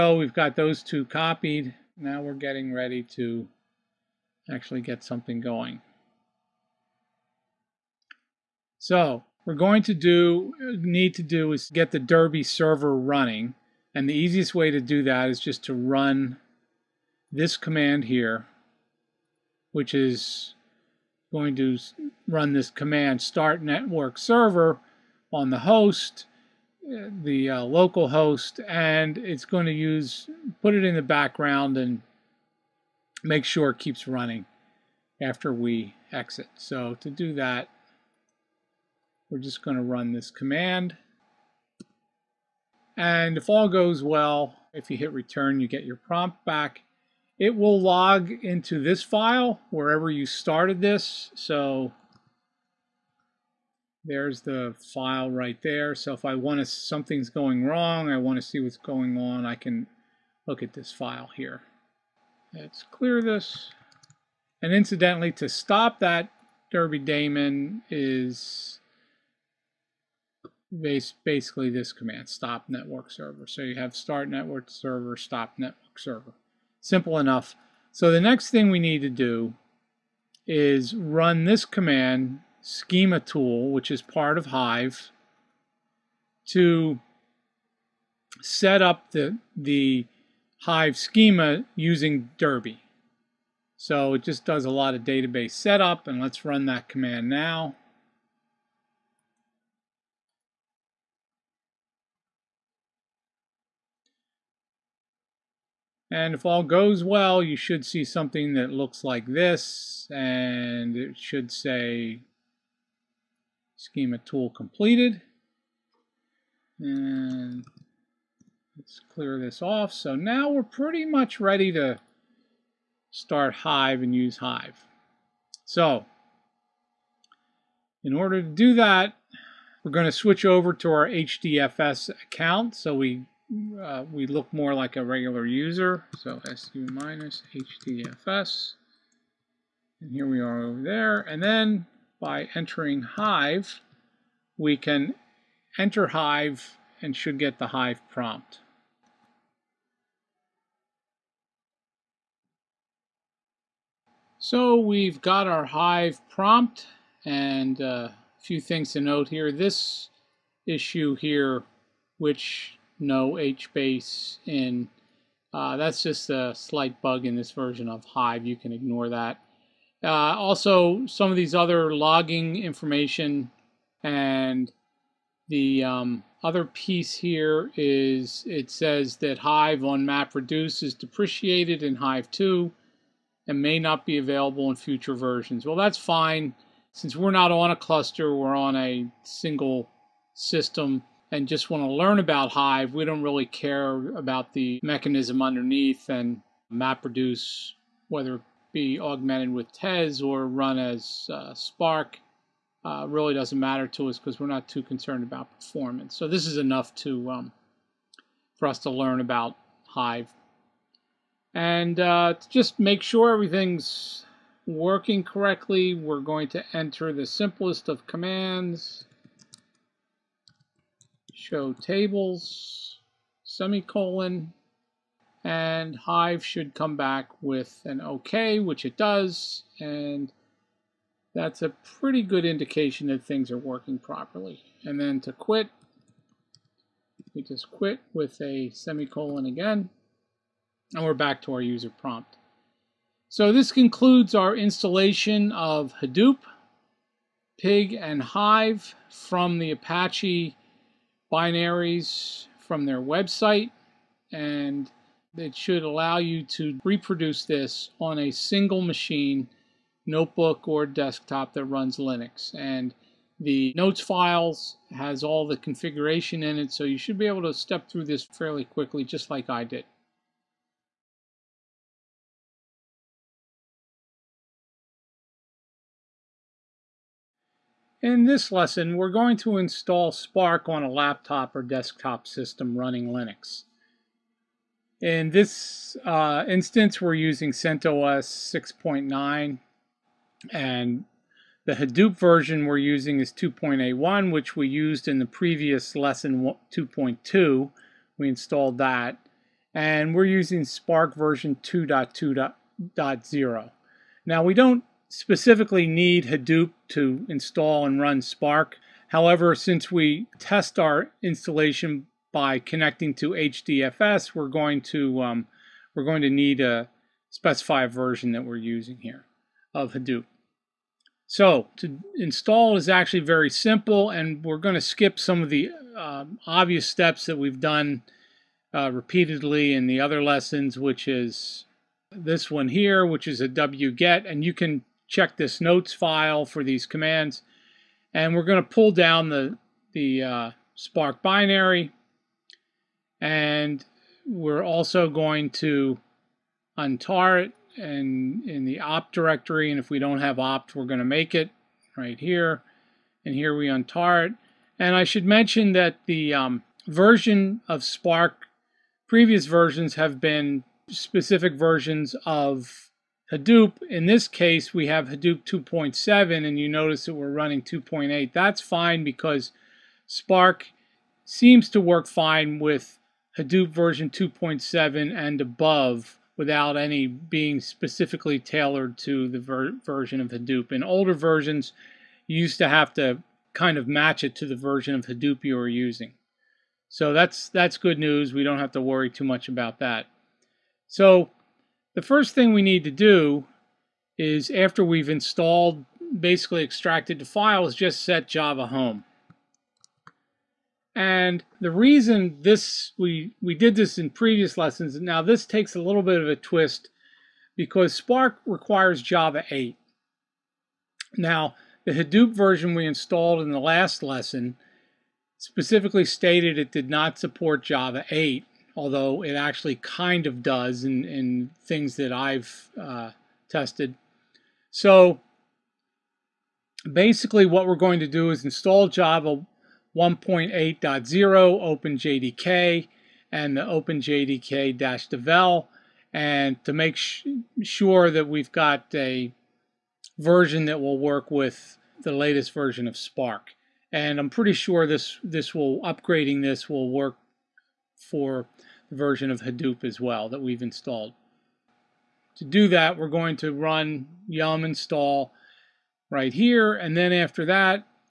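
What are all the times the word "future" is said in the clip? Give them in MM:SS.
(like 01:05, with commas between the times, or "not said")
03:04.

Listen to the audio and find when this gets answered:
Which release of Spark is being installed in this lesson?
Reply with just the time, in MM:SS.
05:01.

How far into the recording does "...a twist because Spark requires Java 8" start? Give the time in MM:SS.
06:46.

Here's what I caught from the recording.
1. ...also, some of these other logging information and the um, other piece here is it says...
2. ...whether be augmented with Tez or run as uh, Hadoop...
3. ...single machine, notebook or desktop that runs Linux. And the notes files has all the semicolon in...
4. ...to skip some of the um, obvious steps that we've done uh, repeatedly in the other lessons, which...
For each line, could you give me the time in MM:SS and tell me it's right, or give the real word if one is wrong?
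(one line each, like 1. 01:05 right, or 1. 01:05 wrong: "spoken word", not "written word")
1. 02:50 right
2. 03:18 wrong: "Spark", not "Hadoop"
3. 04:18 wrong: "configuration", not "semicolon"
4. 05:24 right.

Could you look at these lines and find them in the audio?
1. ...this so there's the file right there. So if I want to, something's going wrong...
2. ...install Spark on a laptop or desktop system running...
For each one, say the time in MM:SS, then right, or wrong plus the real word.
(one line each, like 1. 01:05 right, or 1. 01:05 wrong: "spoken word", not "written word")
1. 00:50 right
2. 04:39 right.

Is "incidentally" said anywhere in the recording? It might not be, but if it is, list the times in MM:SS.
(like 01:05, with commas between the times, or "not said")
01:04.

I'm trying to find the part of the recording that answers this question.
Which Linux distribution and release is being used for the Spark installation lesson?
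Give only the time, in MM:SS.
04:47.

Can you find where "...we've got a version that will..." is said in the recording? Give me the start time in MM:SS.
07:18.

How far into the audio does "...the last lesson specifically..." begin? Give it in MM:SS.
06:53.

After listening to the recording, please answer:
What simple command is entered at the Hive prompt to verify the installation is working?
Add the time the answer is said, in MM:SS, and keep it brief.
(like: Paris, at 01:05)
show tables, at 03:41.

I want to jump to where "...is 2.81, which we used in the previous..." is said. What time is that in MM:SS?
04:53.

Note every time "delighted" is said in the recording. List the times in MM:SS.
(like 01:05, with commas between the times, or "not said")
not said.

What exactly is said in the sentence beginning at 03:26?
So this is enough to um, for us to learn about Hive.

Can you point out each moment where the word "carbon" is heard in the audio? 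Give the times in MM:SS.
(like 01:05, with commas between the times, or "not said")
not said.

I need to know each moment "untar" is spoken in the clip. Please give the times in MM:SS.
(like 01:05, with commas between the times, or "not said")
05:46, 05:53.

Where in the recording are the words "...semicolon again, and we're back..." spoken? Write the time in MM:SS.
03:58.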